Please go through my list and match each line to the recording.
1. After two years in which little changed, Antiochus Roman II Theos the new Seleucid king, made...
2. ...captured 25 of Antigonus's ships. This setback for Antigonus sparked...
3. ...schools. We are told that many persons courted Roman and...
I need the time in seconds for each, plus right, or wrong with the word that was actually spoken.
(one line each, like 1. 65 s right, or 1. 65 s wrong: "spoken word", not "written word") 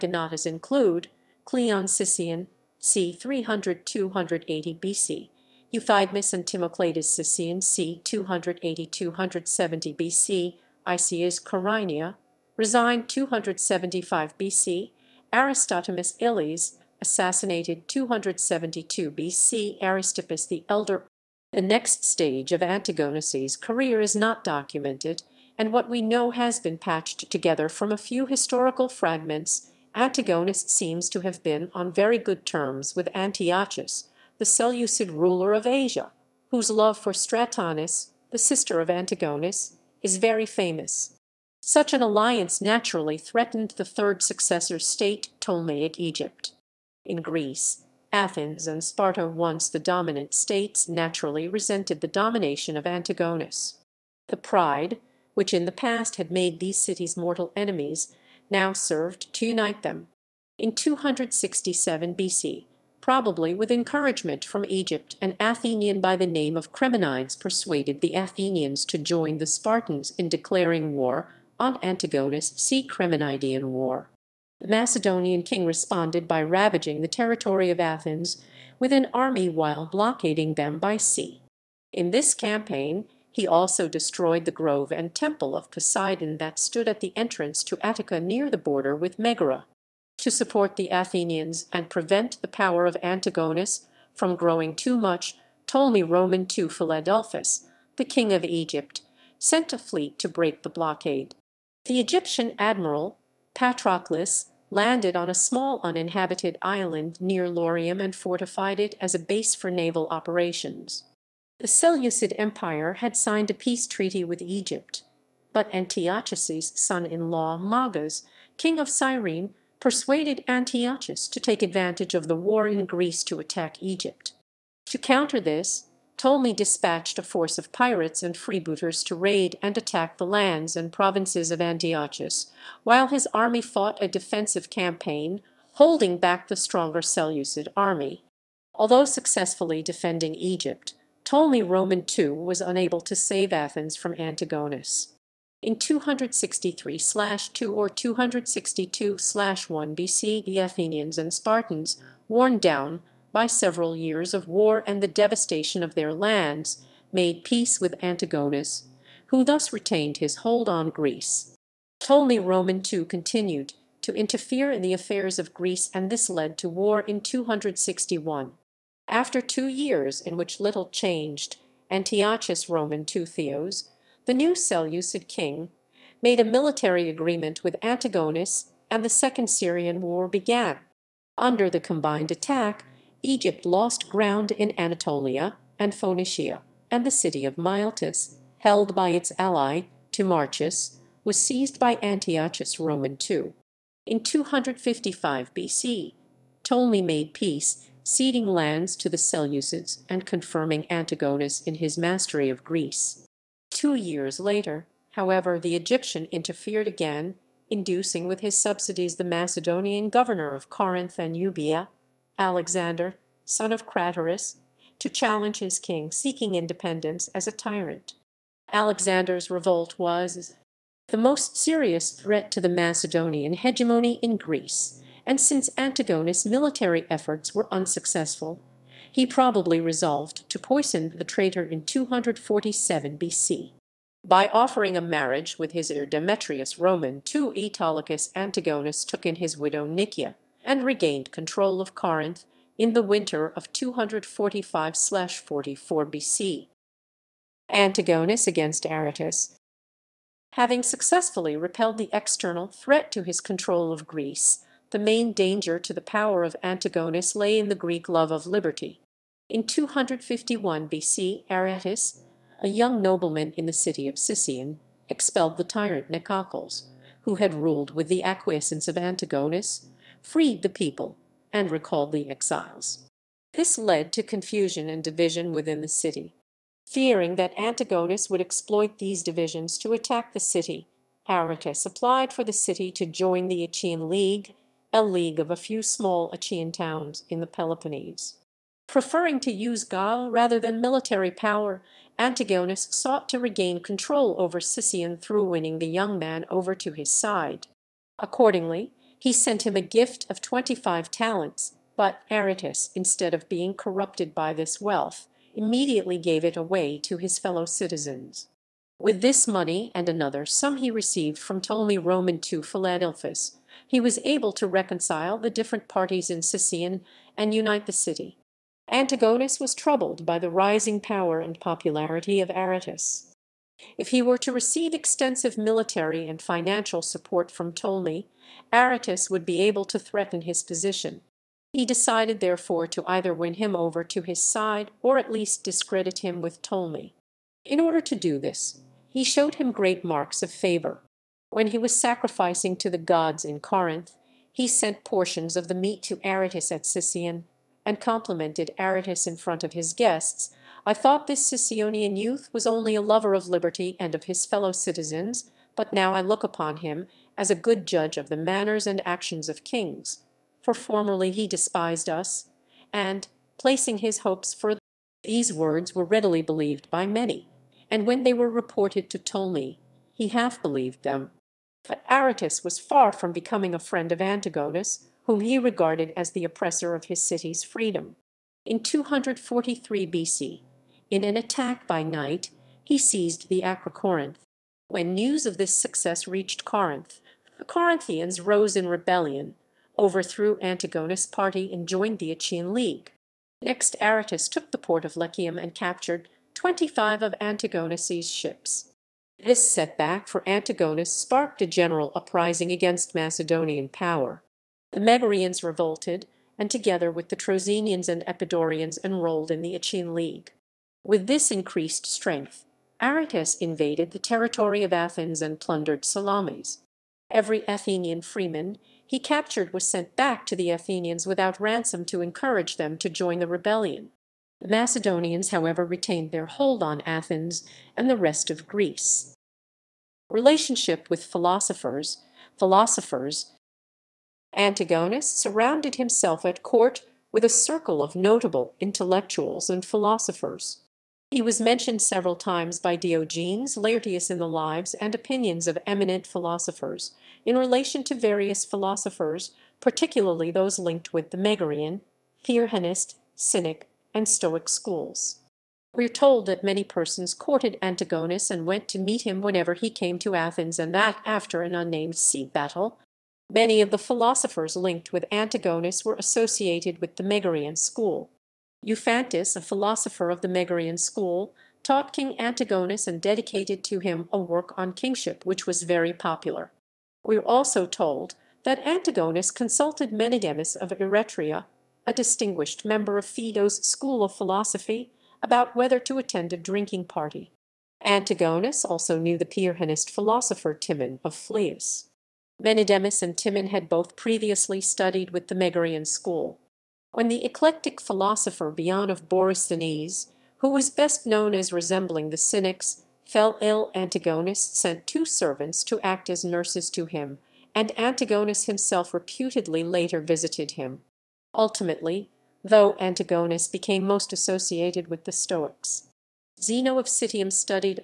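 1. 169 s right
2. 395 s right
3. 454 s wrong: "Antigonus", not "Roman".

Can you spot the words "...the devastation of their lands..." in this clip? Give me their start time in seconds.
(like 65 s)
155 s.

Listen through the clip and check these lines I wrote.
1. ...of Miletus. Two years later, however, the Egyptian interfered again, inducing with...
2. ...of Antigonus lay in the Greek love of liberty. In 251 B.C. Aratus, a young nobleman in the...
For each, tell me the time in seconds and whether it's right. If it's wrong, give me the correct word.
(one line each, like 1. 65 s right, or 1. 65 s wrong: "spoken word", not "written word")
1. 202 s wrong: "Greece", not "Miletus"
2. 256 s right.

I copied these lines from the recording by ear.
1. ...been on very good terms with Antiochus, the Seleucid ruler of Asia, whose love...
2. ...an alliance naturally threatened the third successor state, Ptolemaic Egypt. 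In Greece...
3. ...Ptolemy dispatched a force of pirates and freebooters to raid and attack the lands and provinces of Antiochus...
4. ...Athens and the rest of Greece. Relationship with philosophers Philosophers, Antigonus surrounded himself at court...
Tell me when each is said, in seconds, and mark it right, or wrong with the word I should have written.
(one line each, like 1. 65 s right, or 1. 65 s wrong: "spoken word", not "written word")
1. 31 s right
2. 41 s right
3. 126 s right
4. 427 s right.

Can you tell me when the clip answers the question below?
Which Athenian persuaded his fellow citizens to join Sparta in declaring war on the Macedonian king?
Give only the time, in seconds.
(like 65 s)
66 s.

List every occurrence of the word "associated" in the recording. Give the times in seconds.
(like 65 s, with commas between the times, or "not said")
466 s, 514 s.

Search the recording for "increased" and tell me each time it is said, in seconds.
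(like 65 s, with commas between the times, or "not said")
411 s.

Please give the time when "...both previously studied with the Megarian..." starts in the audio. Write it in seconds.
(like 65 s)
493 s.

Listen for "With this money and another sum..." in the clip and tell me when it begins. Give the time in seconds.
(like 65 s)
308 s.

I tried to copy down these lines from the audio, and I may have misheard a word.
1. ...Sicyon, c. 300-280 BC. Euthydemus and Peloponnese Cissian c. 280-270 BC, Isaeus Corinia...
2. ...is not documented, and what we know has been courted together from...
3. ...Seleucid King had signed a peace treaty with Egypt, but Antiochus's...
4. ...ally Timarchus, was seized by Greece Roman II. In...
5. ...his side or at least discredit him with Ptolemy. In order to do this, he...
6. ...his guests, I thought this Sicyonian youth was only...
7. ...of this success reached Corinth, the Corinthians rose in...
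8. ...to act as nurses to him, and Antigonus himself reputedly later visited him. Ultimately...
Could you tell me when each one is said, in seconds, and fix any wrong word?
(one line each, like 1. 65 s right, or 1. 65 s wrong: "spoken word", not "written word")
1. 1 s wrong: "Timocleides", not "Peloponnese"
2. 24 s wrong: "patched", not "courted"
3. 111 s wrong: "Empire", not "King"
4. 189 s wrong: "Antiochus", not "Greece"
5. 334 s right
6. 349 s right
7. 385 s right
8. 505 s right.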